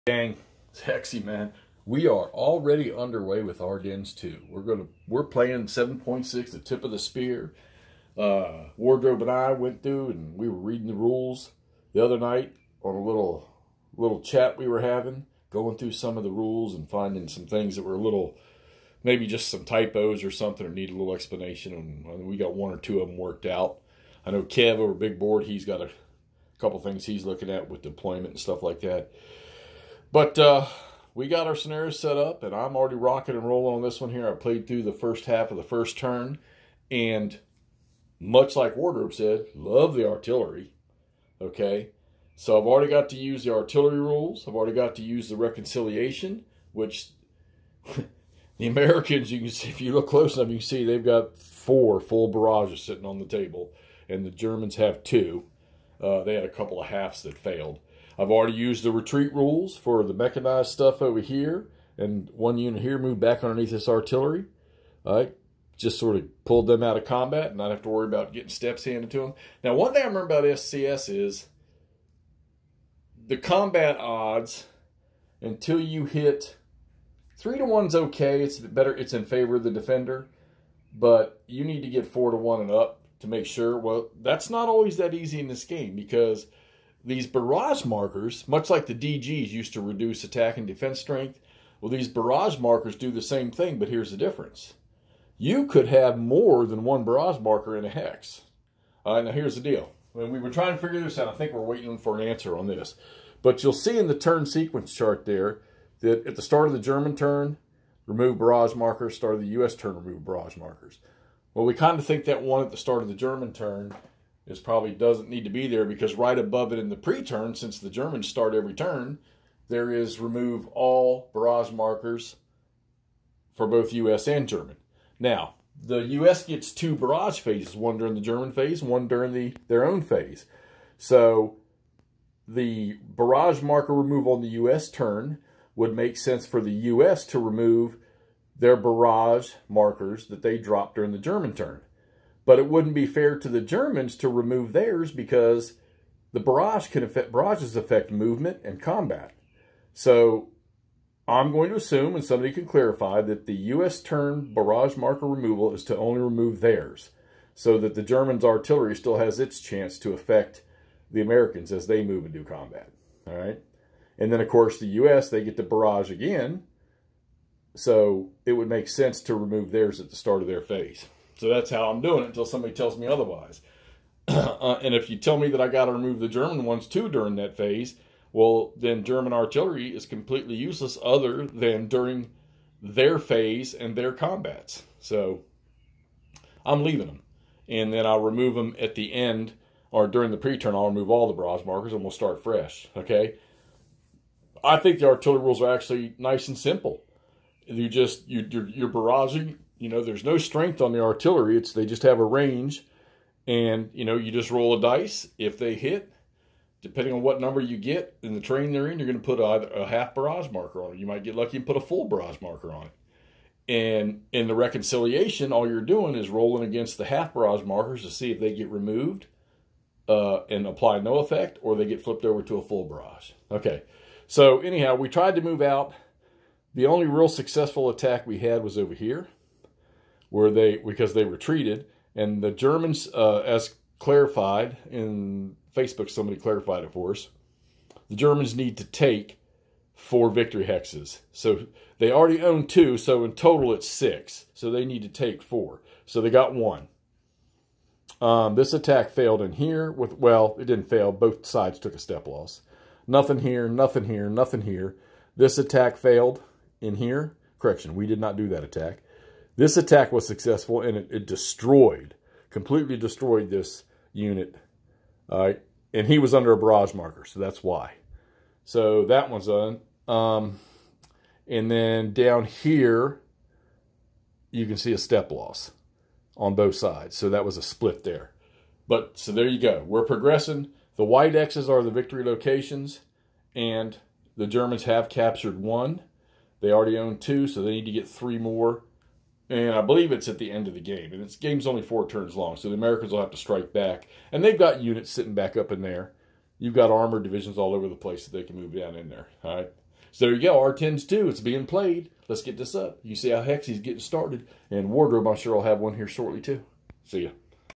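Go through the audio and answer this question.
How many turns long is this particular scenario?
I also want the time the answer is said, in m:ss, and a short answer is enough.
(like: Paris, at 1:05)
4, at 4:51.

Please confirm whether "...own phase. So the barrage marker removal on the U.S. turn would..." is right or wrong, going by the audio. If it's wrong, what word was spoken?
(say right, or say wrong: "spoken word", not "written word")
right.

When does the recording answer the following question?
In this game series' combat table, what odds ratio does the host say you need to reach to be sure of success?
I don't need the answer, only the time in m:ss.
1:22.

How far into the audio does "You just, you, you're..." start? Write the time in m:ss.
3:17.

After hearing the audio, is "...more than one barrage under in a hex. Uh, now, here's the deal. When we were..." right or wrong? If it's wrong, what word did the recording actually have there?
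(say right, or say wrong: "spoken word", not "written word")
wrong: "marker", not "under".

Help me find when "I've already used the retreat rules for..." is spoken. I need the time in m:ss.
0:58.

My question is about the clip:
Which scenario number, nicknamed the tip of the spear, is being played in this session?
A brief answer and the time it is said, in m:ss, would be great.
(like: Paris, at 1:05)
7.6, at 0:05.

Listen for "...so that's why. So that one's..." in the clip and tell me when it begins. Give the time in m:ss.
4:27.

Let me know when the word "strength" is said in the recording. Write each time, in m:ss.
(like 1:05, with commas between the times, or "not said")
1:30, 3:20.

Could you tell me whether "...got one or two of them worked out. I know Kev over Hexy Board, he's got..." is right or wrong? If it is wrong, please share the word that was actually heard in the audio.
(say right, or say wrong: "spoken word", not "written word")
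wrong: "Big", not "Hexy".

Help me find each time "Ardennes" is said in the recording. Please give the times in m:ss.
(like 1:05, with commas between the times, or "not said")
0:03, 5:00.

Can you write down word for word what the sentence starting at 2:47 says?
So it would make sense to remove theirs at the start of their phase.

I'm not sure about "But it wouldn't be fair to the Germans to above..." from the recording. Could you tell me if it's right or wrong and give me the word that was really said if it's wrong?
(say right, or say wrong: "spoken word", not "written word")
wrong: "remove", not "above".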